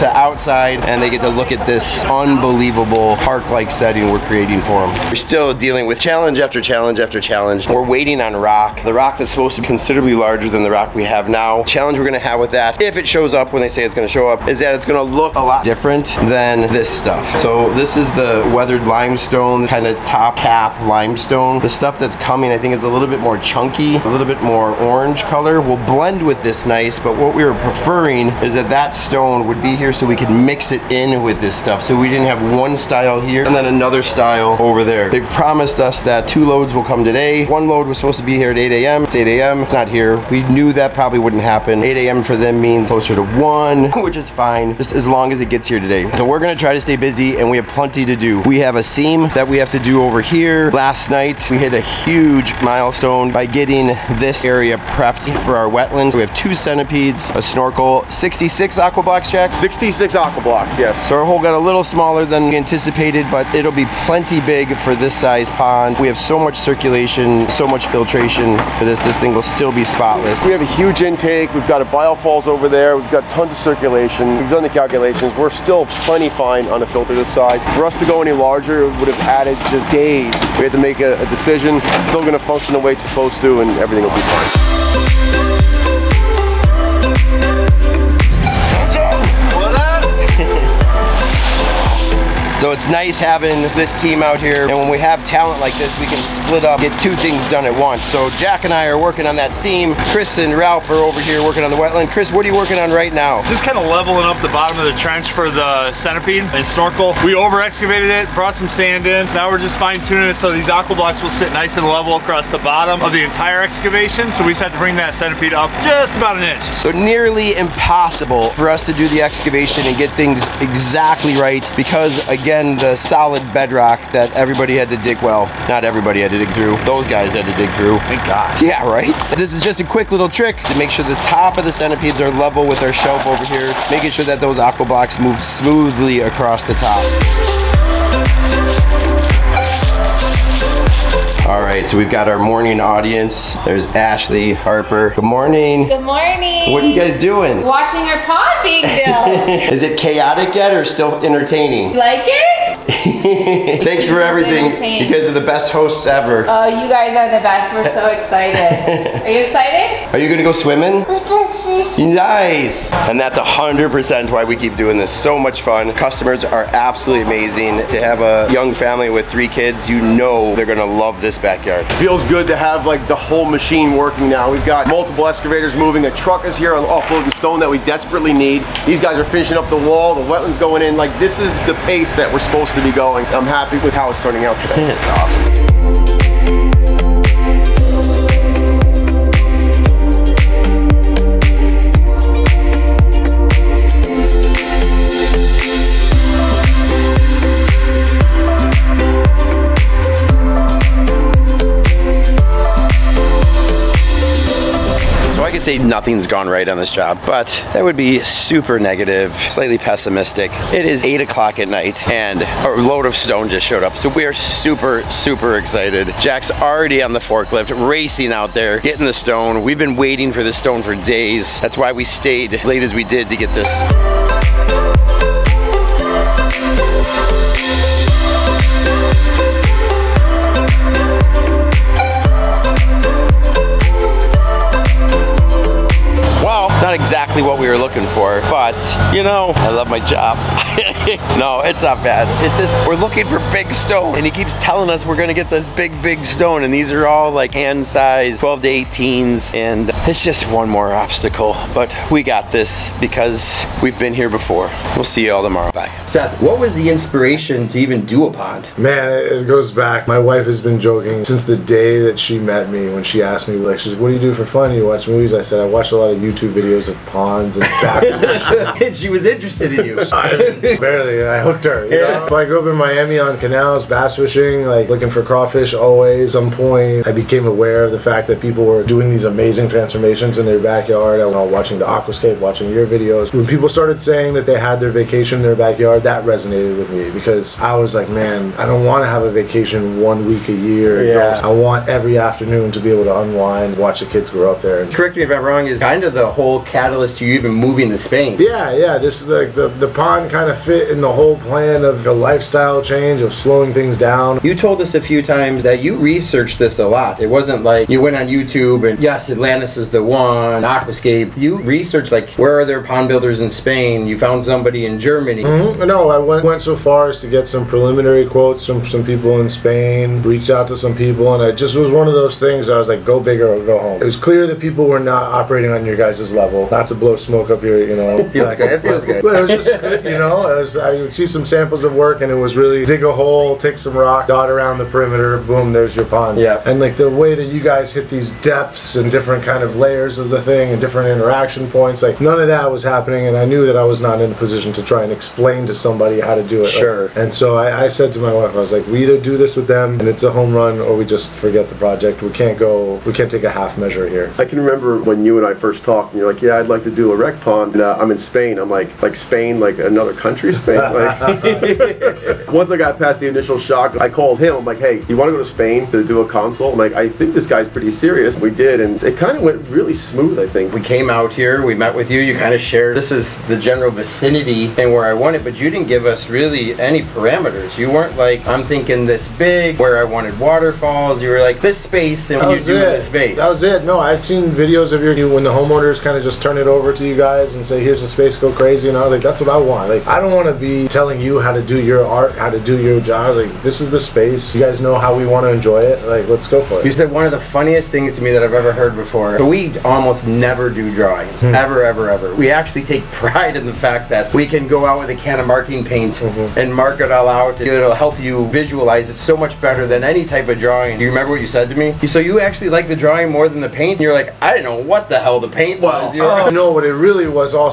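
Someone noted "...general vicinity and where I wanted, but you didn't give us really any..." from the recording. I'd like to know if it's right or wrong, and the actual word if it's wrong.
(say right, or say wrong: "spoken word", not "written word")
right.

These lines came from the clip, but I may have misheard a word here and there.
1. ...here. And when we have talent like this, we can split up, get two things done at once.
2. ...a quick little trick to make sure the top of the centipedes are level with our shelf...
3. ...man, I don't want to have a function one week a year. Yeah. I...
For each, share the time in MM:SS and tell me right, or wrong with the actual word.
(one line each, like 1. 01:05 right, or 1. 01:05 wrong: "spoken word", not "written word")
1. 01:34 right
2. 02:09 right
3. 04:48 wrong: "vacation", not "function".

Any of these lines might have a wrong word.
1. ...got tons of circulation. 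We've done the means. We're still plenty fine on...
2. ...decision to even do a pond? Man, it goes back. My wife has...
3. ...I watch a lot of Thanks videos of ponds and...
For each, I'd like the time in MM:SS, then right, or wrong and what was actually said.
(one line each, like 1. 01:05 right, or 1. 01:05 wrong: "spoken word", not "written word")
1. 01:13 wrong: "calculations", not "means"
2. 04:16 wrong: "inspiration", not "decision"
3. 04:25 wrong: "YouTube", not "Thanks".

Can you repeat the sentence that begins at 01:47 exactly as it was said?
We over excavated it, brought some sand in.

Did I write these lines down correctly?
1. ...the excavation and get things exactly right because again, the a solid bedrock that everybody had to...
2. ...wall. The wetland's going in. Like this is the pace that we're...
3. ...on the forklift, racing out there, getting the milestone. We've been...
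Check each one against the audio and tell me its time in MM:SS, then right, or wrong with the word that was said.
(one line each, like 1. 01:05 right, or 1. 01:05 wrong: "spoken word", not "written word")
1. 01:59 right
2. 02:59 right
3. 03:37 wrong: "stone", not "milestone".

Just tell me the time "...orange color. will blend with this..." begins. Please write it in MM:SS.
00:24.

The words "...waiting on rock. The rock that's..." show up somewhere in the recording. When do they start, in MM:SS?
00:07.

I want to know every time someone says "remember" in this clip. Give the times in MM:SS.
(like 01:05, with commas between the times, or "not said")
05:54, 06:51.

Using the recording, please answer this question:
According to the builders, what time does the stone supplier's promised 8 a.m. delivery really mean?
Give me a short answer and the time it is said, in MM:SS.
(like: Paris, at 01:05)
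1, at 00:42.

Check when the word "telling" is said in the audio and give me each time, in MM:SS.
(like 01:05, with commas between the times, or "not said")
04:04, 06:30.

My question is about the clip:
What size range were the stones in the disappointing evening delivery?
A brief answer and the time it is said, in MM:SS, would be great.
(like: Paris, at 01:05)
12 to 18, at 04:08.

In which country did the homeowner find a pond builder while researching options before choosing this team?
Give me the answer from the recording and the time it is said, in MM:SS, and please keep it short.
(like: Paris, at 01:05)
Germany, at 05:14.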